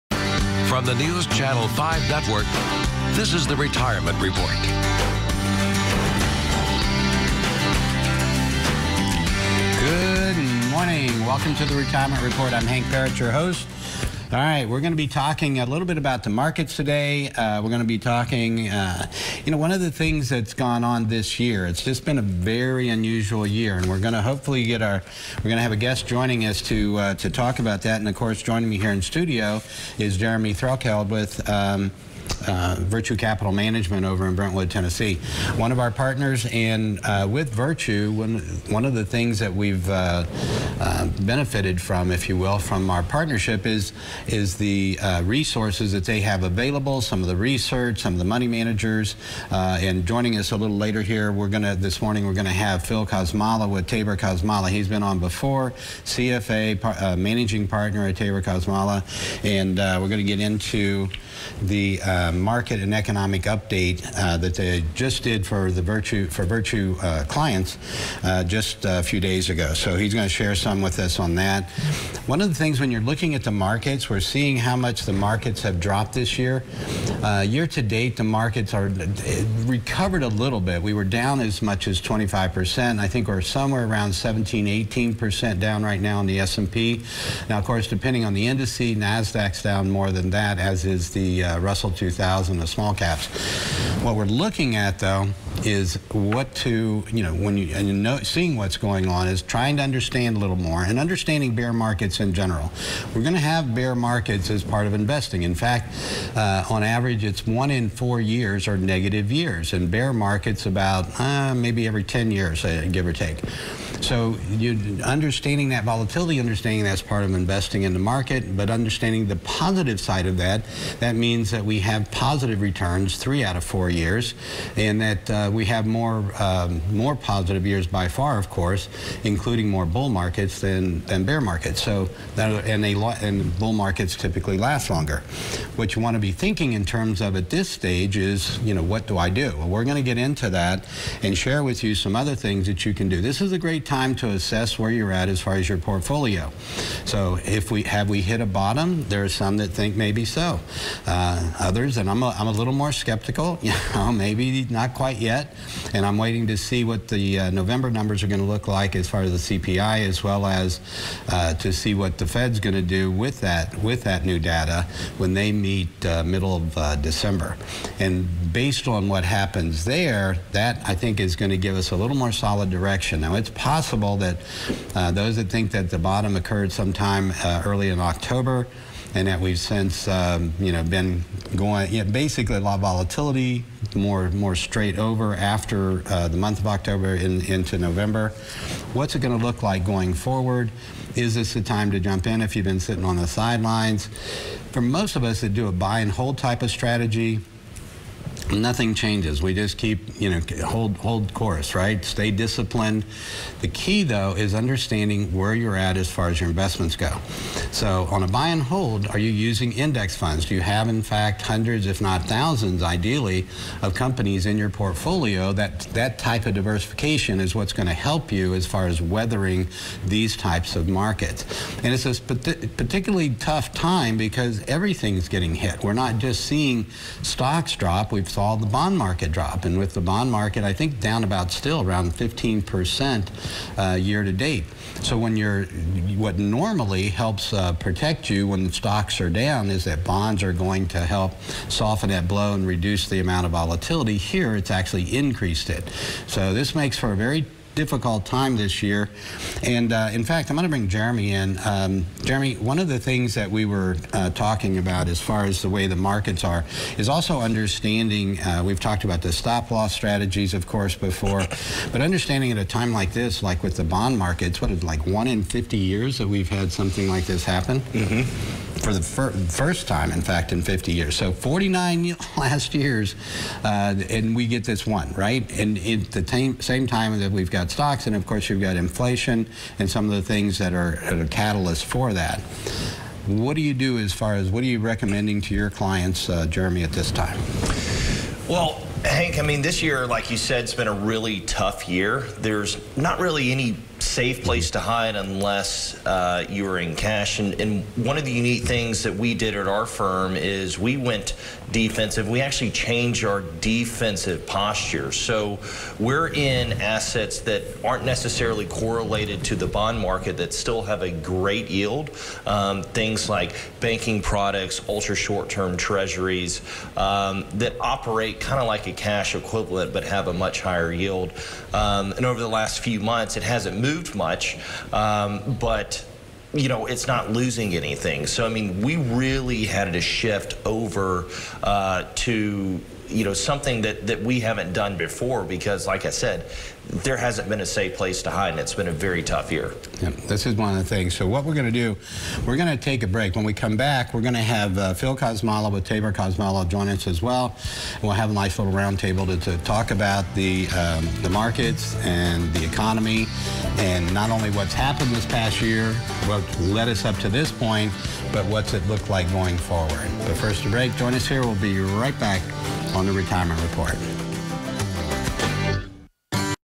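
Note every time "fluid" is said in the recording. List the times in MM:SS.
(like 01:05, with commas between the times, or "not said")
not said.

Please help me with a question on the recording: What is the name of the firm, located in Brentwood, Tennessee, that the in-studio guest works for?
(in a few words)
Virtue Capital Management.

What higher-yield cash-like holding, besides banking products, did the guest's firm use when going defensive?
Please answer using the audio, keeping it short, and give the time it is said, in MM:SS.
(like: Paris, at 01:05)
ultra short-term treasuries, at 05:14.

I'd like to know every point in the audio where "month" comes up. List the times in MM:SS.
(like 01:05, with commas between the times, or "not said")
03:06, 05:22.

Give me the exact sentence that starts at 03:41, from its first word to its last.
And it's a particularly tough time because everything's getting hit.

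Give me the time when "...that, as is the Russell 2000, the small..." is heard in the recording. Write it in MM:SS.
01:30.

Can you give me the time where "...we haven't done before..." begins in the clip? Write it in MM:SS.
05:34.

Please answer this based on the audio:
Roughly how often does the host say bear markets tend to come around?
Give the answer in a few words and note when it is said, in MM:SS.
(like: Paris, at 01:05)
every 10 years, at 01:51.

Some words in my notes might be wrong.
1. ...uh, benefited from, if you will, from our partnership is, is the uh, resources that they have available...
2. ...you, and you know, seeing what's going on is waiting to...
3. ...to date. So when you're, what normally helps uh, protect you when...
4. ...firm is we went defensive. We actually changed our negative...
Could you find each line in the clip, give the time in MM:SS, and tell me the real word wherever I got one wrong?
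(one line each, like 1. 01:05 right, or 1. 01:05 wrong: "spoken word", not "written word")
1. 00:40 right
2. 01:37 wrong: "trying", not "waiting"
3. 03:54 right
4. 04:59 wrong: "defensive", not "negative".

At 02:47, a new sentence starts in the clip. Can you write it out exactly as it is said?
And based on what happens there, that I think is going to give us a little more solid direction.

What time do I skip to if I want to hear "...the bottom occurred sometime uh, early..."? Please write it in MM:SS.
02:55.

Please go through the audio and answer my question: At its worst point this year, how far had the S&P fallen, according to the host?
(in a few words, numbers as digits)
25 percent.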